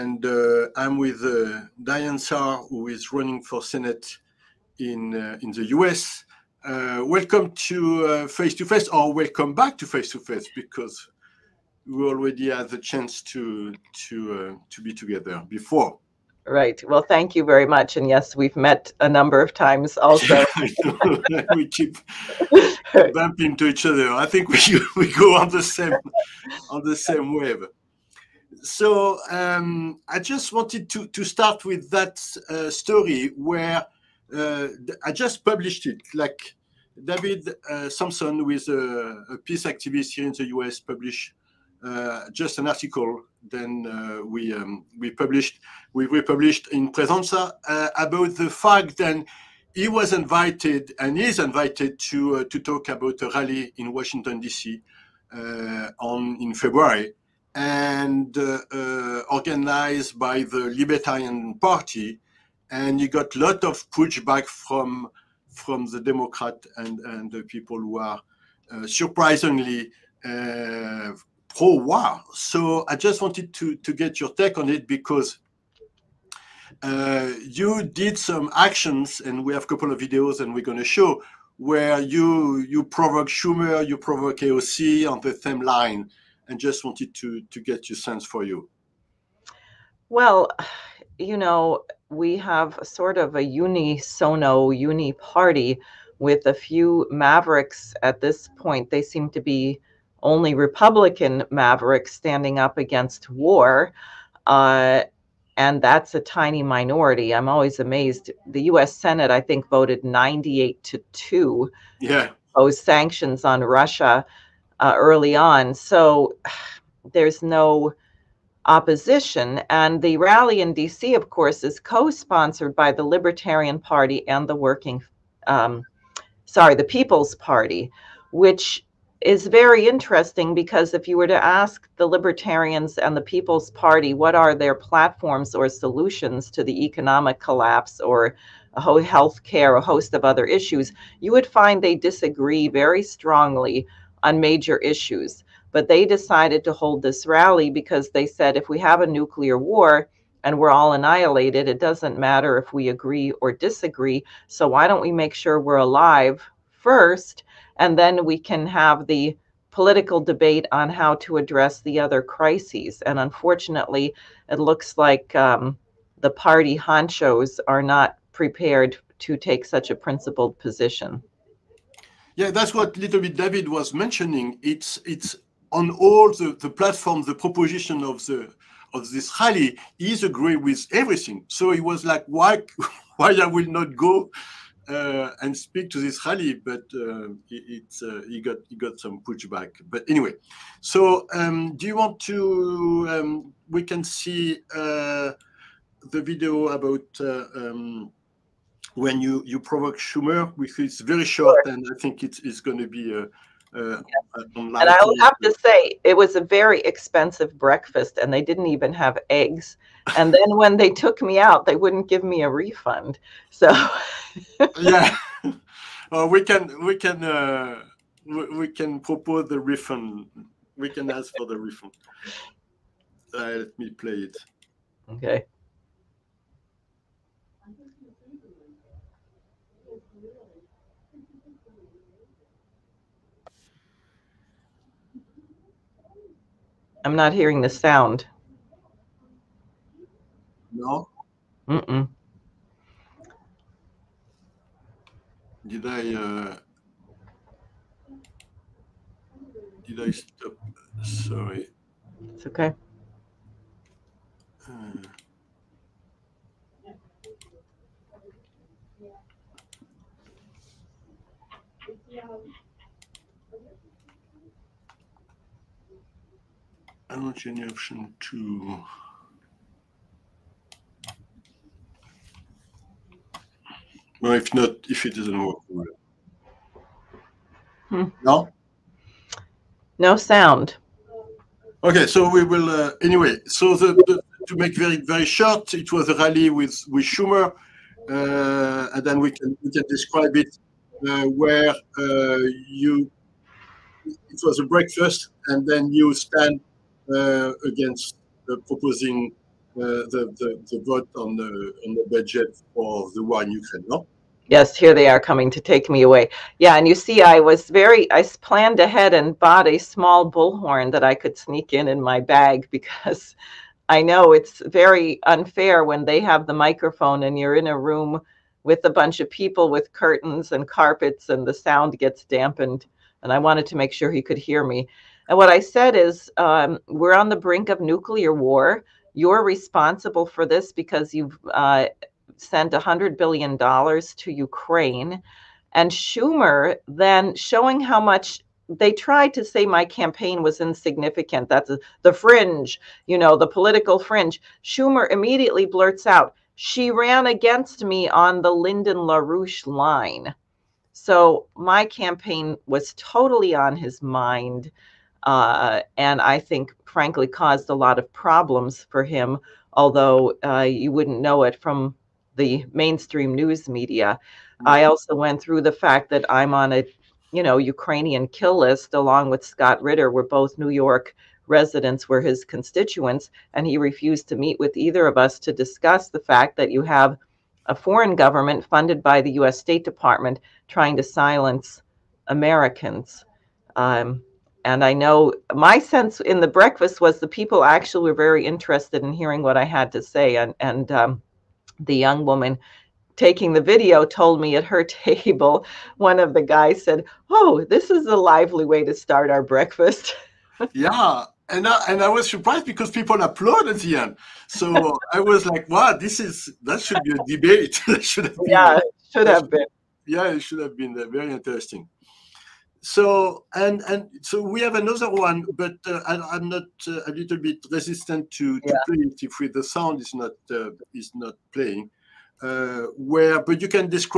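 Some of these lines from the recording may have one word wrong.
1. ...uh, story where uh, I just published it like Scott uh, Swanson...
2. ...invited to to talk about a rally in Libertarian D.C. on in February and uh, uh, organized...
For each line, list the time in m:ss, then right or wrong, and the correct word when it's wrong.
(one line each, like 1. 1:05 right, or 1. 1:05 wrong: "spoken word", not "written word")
1. 0:32 wrong: "David", not "Scott"
2. 0:51 wrong: "Washington", not "Libertarian".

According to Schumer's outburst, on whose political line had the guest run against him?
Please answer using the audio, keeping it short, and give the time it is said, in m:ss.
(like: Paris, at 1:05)
Lyndon LaRouche, at 5:48.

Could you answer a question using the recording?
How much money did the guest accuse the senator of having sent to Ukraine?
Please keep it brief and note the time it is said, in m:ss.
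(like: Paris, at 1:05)
$100 billion, at 5:32.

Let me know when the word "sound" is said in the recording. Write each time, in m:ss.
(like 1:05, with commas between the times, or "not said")
3:57, 4:40, 5:21, 6:59.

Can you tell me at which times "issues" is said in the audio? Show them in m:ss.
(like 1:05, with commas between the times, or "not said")
2:20, 2:24.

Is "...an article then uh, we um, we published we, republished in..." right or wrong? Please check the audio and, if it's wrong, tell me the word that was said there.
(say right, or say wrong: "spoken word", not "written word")
right.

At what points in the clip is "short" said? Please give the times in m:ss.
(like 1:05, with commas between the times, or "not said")
3:21, 4:45.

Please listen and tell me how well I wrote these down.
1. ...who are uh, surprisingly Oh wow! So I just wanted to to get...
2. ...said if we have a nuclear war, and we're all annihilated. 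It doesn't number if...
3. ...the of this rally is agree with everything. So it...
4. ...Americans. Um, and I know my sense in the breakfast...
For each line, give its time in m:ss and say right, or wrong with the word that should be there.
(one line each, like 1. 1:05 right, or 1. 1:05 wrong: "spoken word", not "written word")
1. 1:07 right
2. 2:28 wrong: "matter", not "number"
3. 2:58 right
4. 6:22 right.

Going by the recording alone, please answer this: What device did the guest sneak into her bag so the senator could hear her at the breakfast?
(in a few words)
small bullhorn.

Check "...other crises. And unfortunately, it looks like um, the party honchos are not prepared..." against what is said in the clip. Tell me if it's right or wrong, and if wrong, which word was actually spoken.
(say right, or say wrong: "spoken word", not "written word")
right.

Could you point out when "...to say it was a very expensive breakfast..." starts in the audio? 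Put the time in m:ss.
3:25.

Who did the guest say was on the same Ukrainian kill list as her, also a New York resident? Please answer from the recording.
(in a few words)
Scott Ritter.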